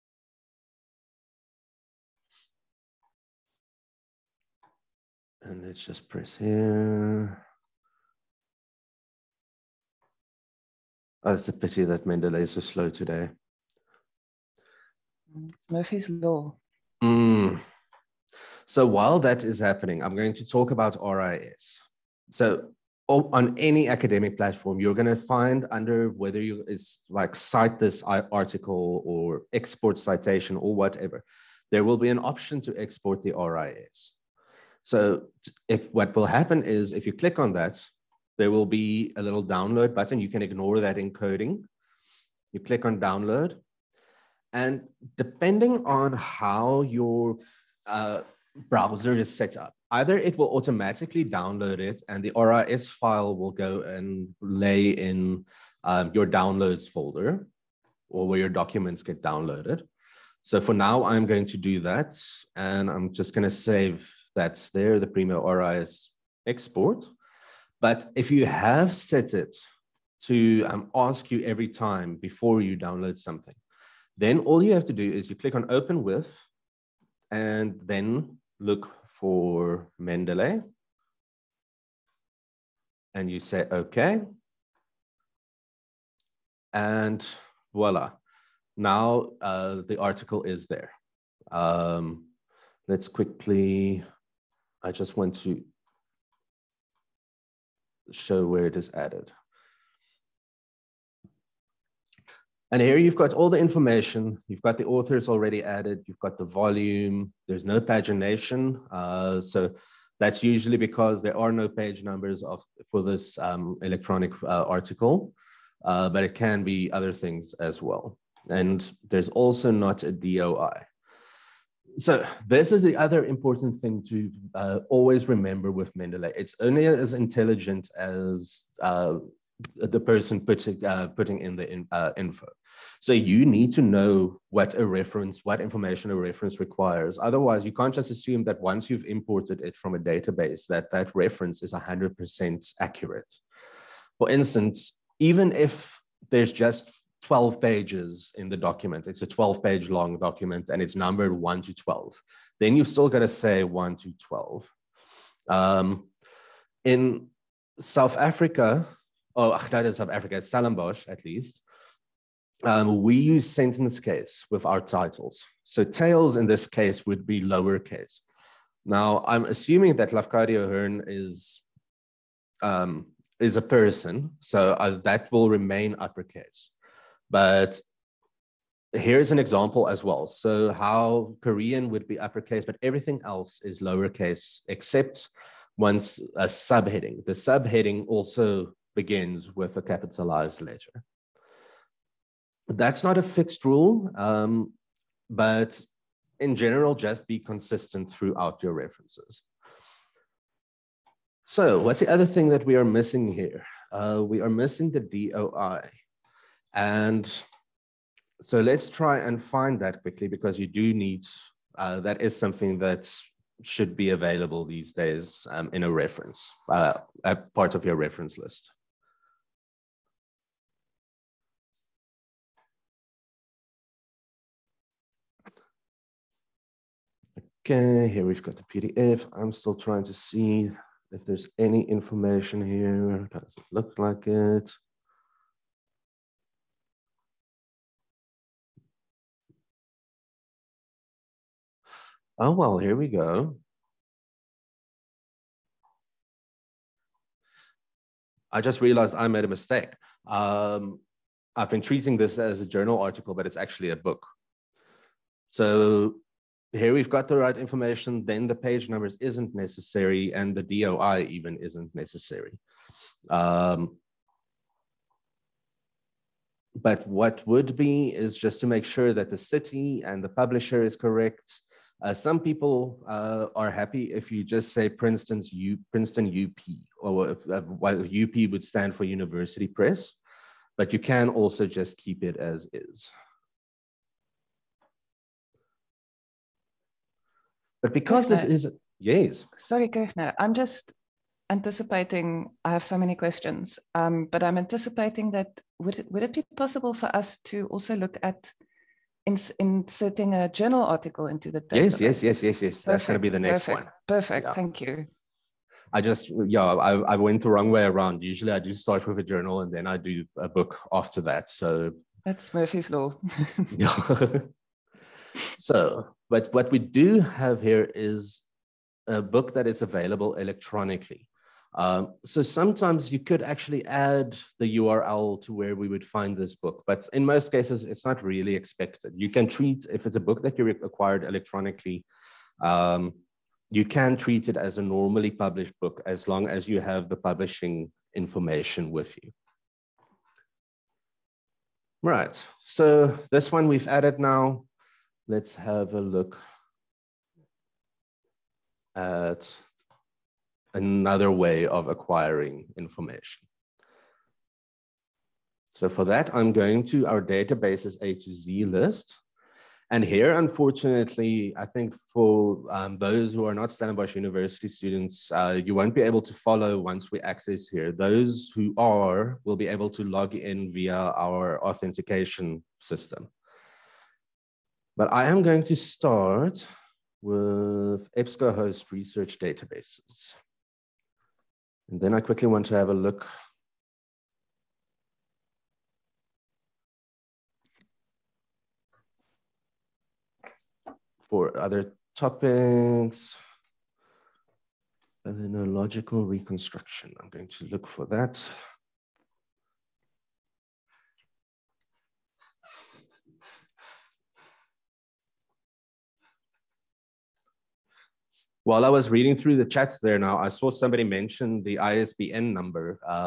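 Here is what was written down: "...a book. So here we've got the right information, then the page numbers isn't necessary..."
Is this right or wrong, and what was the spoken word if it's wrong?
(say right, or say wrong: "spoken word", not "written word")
right.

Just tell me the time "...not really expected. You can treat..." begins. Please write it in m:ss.
5:28.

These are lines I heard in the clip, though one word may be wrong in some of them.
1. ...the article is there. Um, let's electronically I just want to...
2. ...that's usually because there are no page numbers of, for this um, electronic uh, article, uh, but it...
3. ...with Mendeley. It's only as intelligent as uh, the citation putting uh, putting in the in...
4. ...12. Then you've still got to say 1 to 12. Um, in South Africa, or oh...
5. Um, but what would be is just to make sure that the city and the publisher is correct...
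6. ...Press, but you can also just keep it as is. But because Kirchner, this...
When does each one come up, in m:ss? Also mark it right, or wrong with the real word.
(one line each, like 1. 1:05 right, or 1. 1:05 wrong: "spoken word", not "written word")
1. 1:29 wrong: "quickly", not "electronically"
2. 1:50 right
3. 2:05 wrong: "person", not "citation"
4. 2:31 right
5. 4:23 right
6. 4:39 right.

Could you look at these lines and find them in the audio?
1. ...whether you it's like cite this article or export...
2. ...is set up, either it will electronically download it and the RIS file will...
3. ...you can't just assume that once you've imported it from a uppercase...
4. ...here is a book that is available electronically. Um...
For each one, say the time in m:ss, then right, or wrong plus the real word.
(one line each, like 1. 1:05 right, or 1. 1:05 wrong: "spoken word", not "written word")
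1. 0:26 right
2. 0:49 wrong: "automatically", not "electronically"
3. 2:17 wrong: "database", not "uppercase"
4. 5:17 right.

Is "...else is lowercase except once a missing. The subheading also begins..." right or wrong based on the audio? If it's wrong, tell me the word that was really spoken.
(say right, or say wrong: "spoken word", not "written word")
wrong: "subheading", not "missing".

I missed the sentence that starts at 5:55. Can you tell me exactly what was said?
So for that, I'm going to our databases A to Z list.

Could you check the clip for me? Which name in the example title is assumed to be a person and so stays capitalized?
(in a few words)
Lafcadio Hearn.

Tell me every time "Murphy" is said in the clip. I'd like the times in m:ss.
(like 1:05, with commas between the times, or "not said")
0:15, 5:12.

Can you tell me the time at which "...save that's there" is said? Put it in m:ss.
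1:03.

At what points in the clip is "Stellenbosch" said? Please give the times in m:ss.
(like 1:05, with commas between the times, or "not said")
2:40, 6:03.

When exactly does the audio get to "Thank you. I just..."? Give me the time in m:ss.
5:04.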